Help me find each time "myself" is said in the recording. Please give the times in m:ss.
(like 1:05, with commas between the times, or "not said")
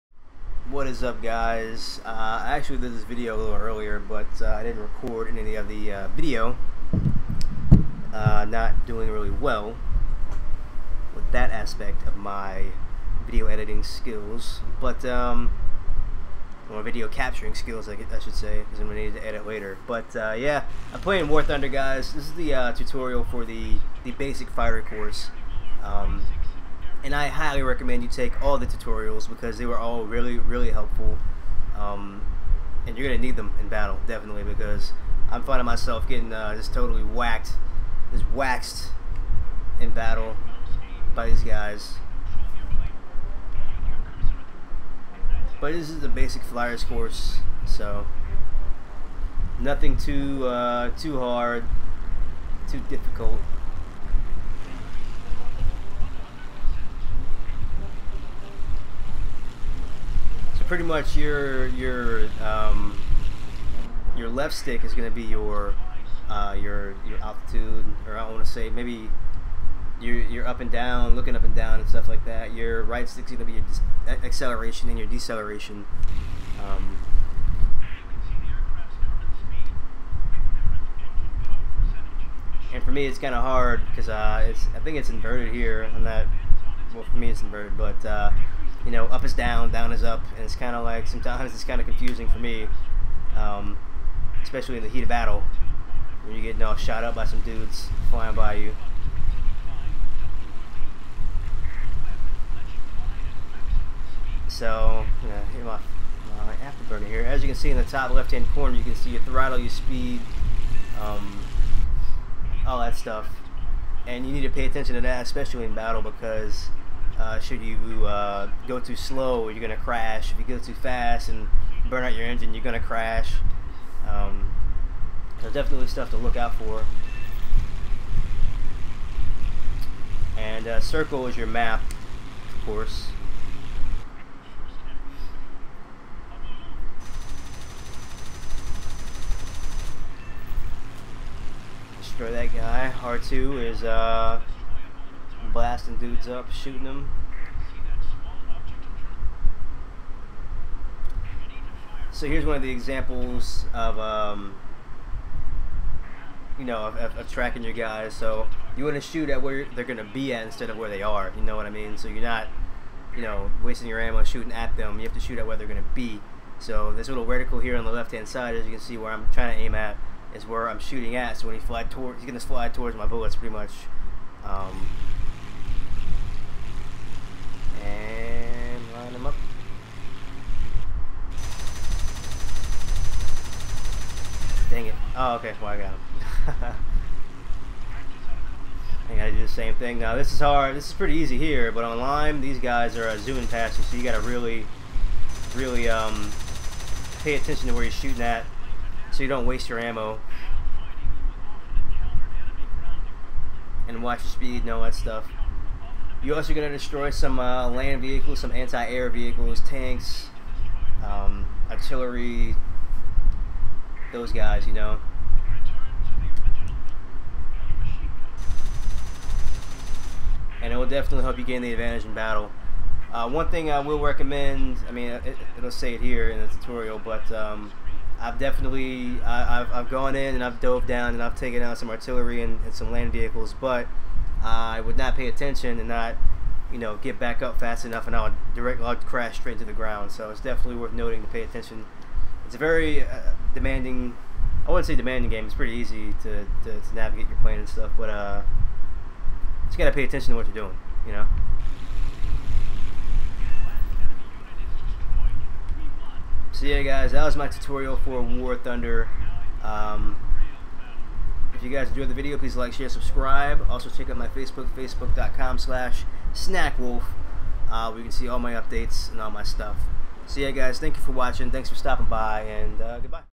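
0:35.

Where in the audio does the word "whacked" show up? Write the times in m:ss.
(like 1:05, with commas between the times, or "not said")
0:37.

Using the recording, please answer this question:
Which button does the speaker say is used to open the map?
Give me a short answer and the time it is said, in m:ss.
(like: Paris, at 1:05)
Circle, at 2:10.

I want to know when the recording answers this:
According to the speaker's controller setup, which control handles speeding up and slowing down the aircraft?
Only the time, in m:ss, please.
1:12.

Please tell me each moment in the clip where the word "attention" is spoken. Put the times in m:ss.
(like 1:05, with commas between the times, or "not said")
1:54, 3:17, 3:55, 4:01, 4:10.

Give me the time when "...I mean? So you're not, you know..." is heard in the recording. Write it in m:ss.
2:41.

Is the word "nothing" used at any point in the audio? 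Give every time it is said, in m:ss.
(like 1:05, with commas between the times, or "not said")
0:49.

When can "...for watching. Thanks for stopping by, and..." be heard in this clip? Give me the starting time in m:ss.
4:31.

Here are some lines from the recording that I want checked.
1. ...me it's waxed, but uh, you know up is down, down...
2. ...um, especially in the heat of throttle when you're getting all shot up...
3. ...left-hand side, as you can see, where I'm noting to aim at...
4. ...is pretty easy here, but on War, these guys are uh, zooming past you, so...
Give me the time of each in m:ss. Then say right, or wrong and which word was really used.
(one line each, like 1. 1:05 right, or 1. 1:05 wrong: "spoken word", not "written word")
1. 1:27 wrong: "inverted", not "waxed"
2. 1:33 wrong: "battle", not "throttle"
3. 2:47 wrong: "trying", not "noting"
4. 3:10 wrong: "Lime", not "War".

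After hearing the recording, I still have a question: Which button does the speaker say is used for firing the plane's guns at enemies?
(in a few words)
R2.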